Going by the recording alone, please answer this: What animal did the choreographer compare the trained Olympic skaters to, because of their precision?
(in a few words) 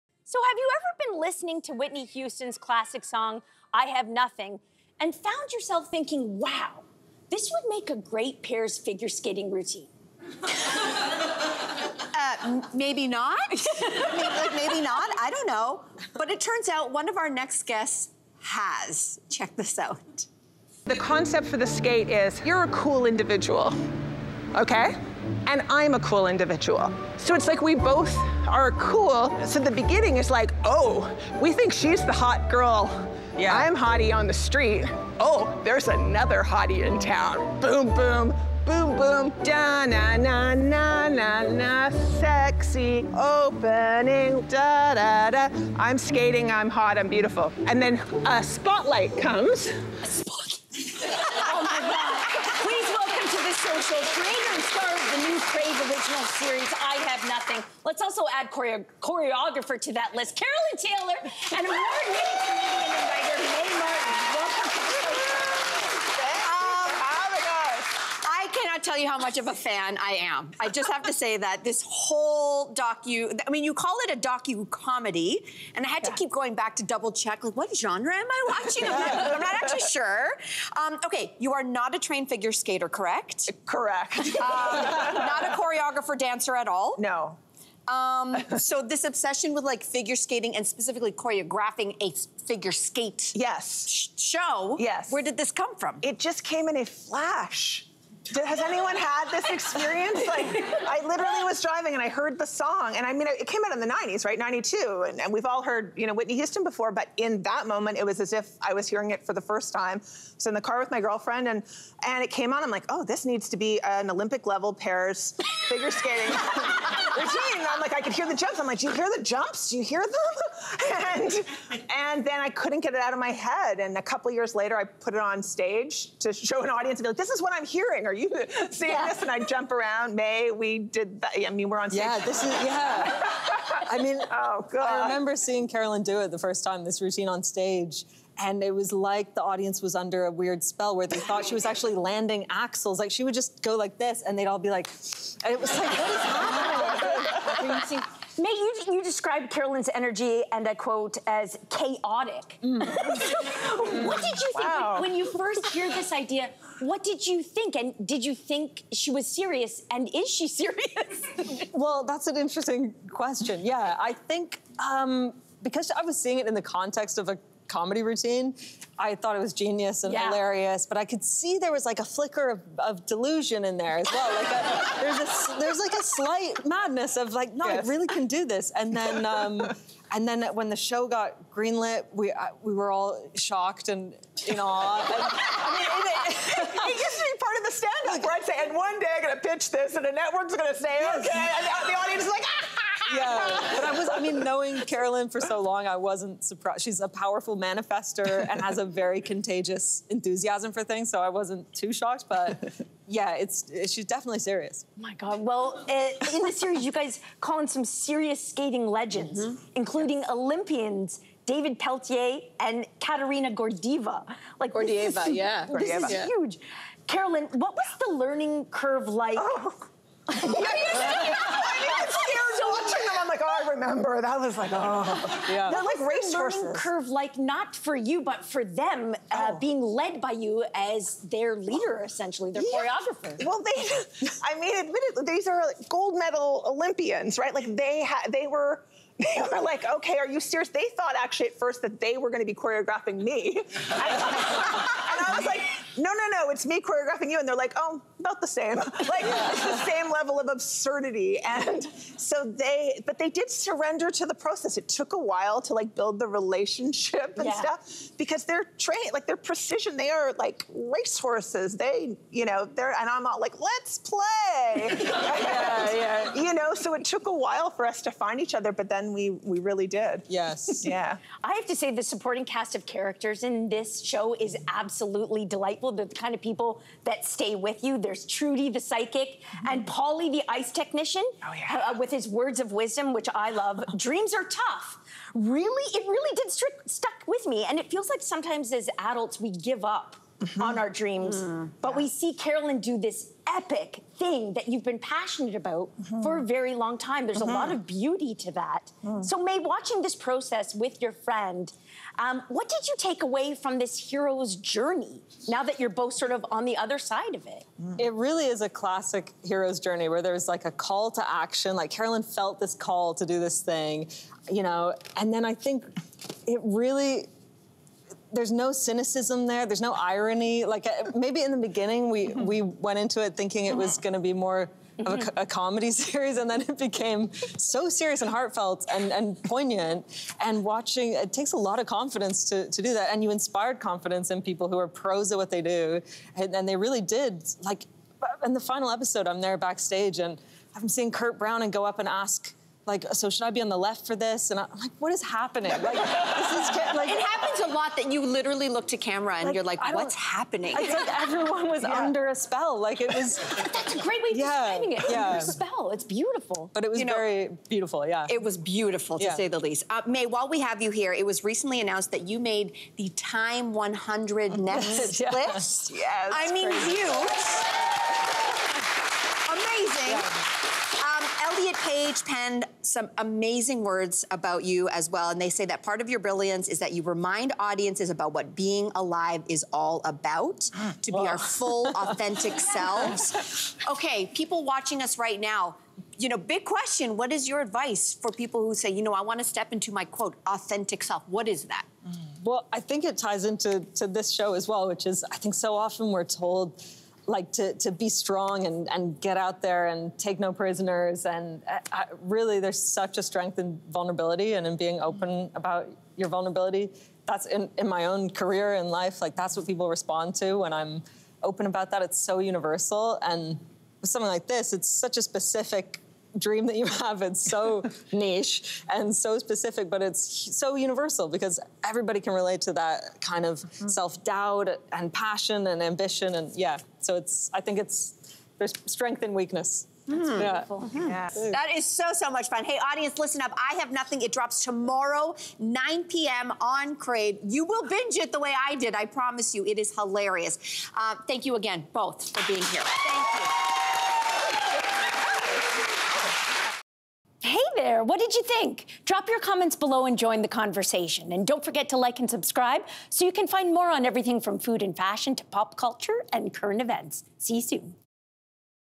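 Racehorses.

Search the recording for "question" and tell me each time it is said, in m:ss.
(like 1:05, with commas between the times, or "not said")
2:43, 6:26.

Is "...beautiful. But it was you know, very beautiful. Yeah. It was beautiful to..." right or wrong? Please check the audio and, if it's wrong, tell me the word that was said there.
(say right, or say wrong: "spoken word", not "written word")
right.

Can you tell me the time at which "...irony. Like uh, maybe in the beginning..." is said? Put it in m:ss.
5:19.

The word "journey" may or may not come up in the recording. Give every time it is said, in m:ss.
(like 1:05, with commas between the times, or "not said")
5:04, 5:09.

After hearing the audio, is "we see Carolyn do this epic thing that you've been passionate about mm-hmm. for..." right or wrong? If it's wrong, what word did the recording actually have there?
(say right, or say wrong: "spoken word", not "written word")
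right.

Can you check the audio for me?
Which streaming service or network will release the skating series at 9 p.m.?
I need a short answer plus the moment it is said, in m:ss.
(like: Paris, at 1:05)
Crave, at 7:16.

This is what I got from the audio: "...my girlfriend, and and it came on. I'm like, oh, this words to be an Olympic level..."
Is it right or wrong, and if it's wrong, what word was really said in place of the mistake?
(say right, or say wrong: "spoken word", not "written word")
wrong: "needs", not "words".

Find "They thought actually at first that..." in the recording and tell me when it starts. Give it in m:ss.
4:00.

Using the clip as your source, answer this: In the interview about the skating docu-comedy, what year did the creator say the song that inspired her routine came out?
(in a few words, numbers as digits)
1992.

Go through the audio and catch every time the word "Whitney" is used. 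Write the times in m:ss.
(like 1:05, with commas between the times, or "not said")
0:01, 1:46.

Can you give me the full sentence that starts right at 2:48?
I thought it was genius and yeah.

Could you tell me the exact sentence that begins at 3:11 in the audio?
okay, and the audience is like, ah!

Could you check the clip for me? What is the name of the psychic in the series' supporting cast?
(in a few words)
Trudy.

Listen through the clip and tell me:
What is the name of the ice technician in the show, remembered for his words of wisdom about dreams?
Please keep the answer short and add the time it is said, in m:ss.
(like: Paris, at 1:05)
Polly, at 4:39.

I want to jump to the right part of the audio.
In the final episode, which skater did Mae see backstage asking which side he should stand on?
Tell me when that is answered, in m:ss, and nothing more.
5:41.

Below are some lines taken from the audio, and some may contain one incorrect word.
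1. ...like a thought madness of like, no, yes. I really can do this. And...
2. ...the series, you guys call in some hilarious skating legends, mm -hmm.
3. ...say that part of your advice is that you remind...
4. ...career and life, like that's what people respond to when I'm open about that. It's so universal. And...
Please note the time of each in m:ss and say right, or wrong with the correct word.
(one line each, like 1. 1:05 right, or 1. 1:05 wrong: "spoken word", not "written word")
1. 2:55 wrong: "slight", not "thought"
2. 3:26 wrong: "serious", not "hilarious"
3. 6:15 wrong: "brilliance", not "advice"
4. 6:48 right.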